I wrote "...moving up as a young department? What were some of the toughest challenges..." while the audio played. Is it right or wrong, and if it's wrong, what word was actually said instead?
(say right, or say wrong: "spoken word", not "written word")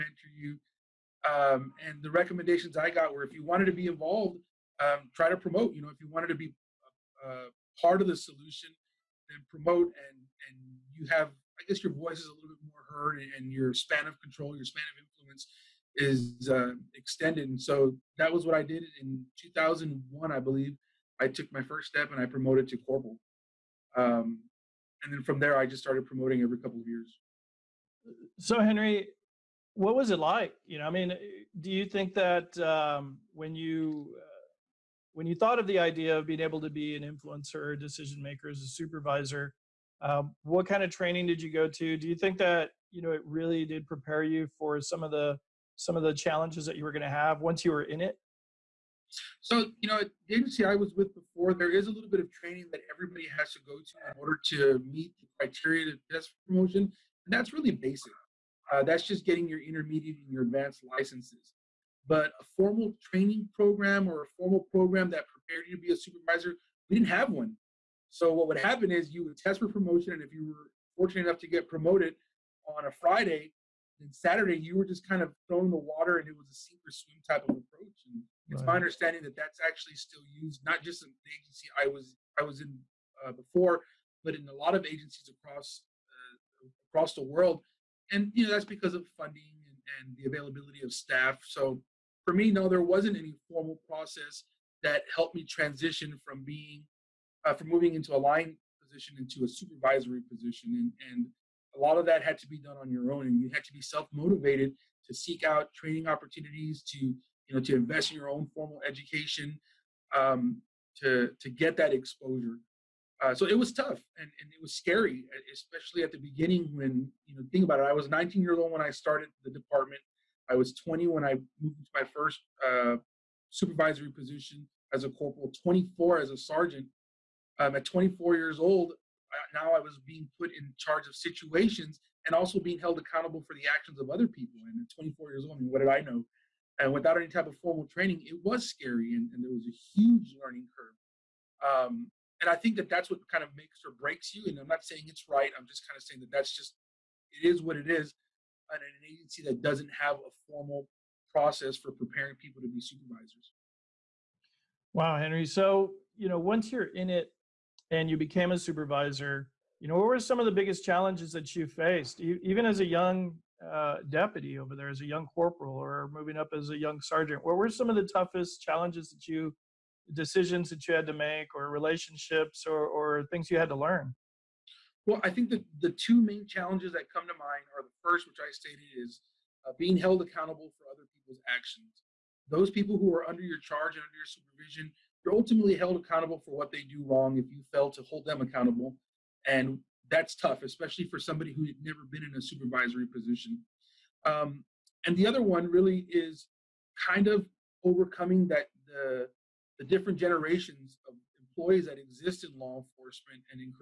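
wrong: "sergeant", not "department".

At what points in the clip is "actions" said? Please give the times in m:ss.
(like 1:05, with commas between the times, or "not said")
2:13, 3:01.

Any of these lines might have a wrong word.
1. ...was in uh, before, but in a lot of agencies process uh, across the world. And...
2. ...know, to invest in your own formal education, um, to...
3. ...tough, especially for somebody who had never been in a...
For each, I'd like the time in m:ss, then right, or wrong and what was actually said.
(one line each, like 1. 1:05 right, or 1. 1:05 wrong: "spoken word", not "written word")
1. 1:22 wrong: "across", not "process"
2. 1:47 right
3. 3:10 right.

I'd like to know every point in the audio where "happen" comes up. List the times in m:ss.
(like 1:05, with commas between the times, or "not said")
1:08.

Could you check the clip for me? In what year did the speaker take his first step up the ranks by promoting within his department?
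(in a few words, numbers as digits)
2001.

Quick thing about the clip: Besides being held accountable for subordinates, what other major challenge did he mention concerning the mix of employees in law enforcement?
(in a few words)
Different generations.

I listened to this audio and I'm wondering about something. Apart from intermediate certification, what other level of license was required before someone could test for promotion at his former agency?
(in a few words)
Advanced.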